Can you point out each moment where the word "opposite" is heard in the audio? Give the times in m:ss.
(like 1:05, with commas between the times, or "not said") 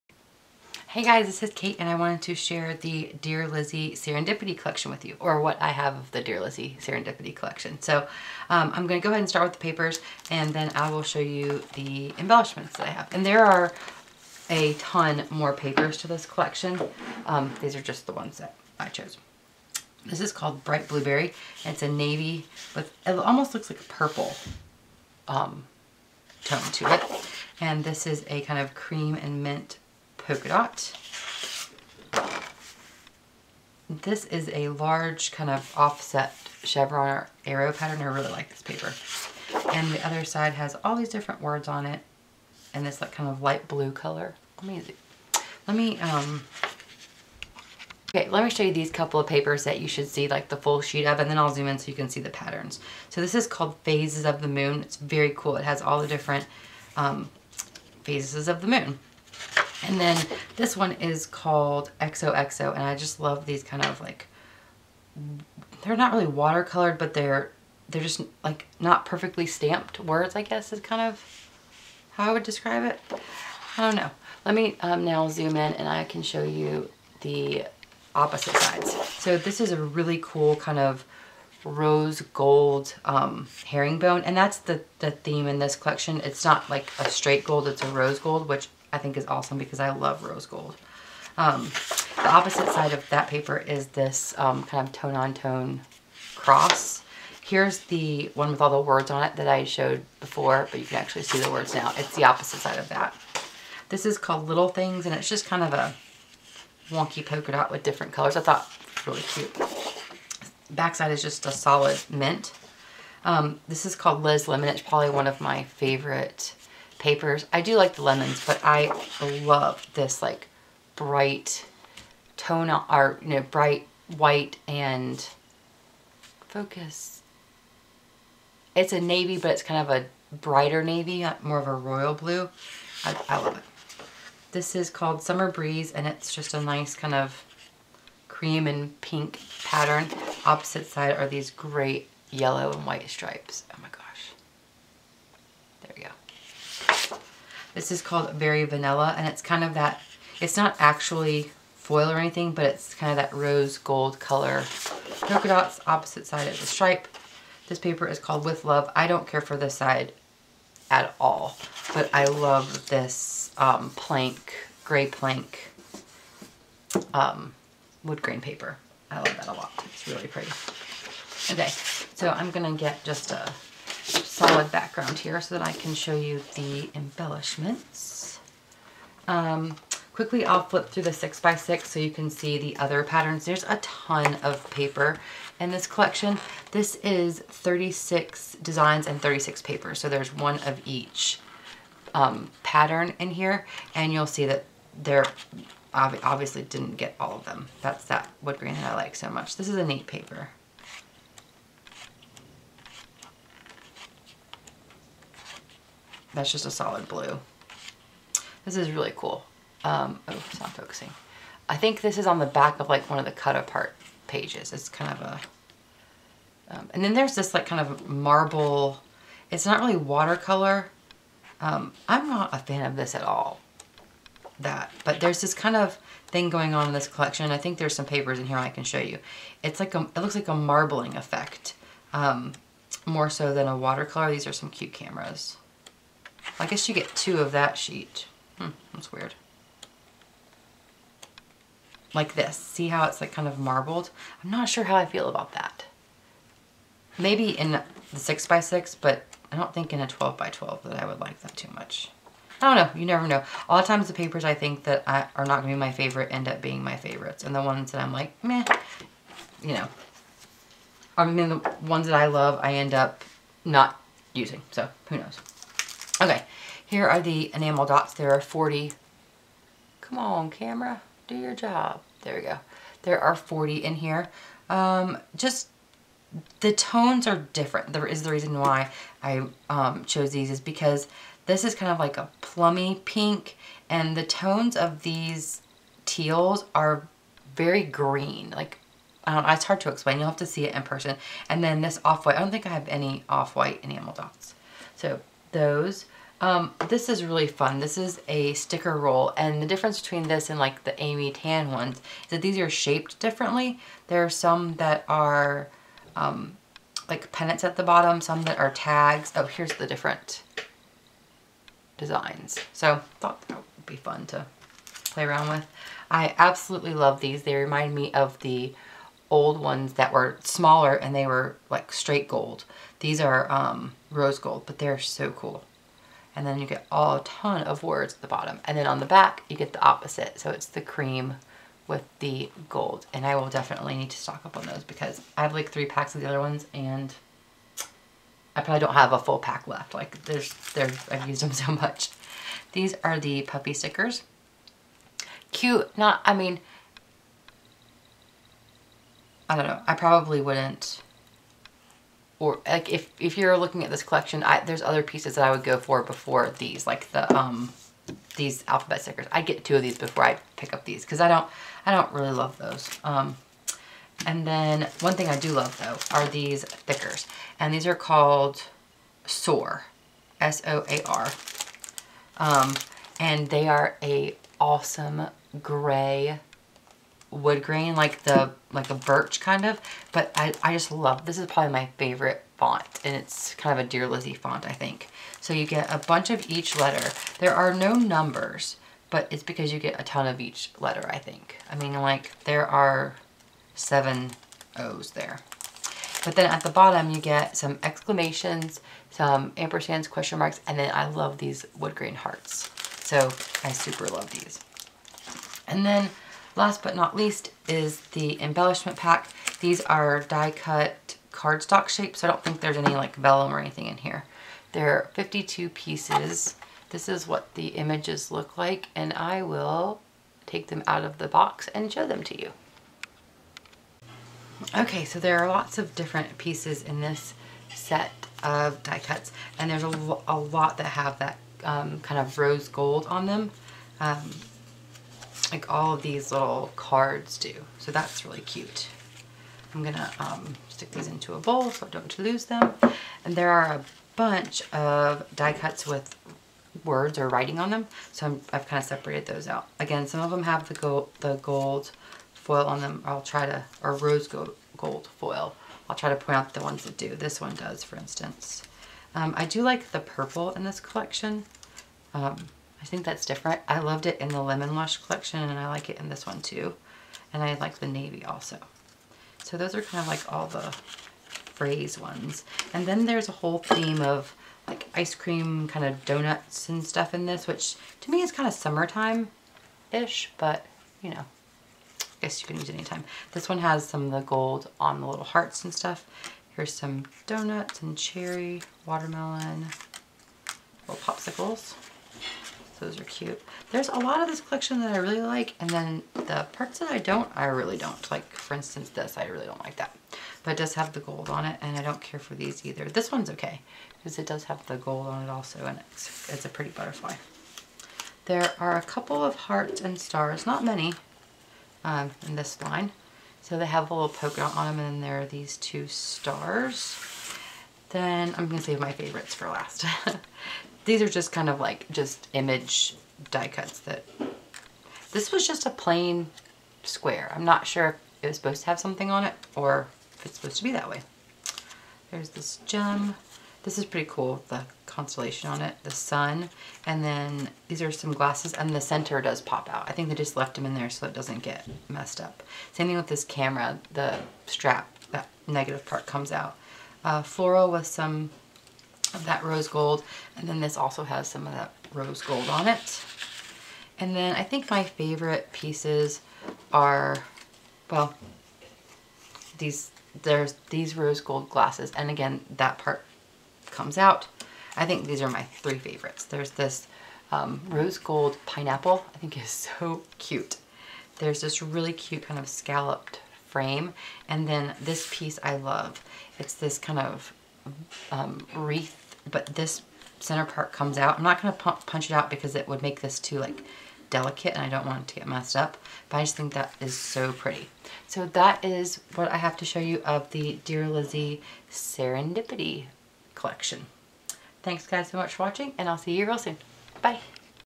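1:18, 1:32, 1:42, 2:20, 2:35, 5:29.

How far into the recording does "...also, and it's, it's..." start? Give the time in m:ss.
8:25.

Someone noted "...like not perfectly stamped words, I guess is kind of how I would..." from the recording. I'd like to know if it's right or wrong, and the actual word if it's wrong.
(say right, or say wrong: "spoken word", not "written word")
right.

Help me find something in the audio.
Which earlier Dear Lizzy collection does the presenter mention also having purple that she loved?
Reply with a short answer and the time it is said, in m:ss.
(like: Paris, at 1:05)
Lemon Lush, at 7:44.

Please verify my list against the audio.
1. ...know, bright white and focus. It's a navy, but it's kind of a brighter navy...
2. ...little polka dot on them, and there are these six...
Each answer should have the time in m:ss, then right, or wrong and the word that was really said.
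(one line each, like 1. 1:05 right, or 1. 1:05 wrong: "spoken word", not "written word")
1. 2:03 right
2. 8:33 wrong: "two", not "six".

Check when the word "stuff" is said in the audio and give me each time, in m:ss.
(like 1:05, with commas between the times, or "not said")
7:56, 8:05.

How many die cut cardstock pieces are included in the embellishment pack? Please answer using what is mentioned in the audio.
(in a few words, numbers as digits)
52.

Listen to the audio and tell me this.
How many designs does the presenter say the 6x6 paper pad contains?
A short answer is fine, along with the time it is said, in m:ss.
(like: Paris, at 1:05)
36, at 3:07.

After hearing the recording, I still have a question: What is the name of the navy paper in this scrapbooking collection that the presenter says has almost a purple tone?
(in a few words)
Bright Blueberry.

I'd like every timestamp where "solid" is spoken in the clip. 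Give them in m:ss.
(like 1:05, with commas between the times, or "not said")
1:51, 2:54, 3:26.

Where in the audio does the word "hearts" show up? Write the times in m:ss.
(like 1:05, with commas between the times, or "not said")
6:42, 8:05, 8:29.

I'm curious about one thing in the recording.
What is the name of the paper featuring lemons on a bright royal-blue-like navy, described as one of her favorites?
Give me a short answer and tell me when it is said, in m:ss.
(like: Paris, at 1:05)
Liz Lemon, at 1:54.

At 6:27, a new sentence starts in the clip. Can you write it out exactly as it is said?
There are no numbers, but it's because you get a ton of each letter, I think.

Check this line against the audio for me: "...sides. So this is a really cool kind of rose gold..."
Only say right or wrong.
right.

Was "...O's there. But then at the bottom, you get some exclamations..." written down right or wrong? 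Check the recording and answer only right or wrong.
right.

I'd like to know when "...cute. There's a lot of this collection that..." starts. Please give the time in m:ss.
8:13.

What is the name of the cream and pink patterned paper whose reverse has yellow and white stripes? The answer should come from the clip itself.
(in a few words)
Summer Breeze.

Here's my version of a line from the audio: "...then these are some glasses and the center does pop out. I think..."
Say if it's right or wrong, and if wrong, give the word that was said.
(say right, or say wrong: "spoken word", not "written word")
right.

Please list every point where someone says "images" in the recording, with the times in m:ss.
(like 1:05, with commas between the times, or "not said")
6:57, 8:42.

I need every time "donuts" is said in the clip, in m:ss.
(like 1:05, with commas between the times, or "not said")
7:56, 8:07.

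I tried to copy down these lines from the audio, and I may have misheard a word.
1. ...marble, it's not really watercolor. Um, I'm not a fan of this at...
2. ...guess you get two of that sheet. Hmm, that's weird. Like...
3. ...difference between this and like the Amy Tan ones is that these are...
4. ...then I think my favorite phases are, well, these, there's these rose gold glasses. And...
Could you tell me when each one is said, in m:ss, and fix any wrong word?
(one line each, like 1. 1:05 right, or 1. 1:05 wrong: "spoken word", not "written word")
1. 3:38 right
2. 3:56 right
3. 4:59 right
4. 9:14 wrong: "pieces", not "phases".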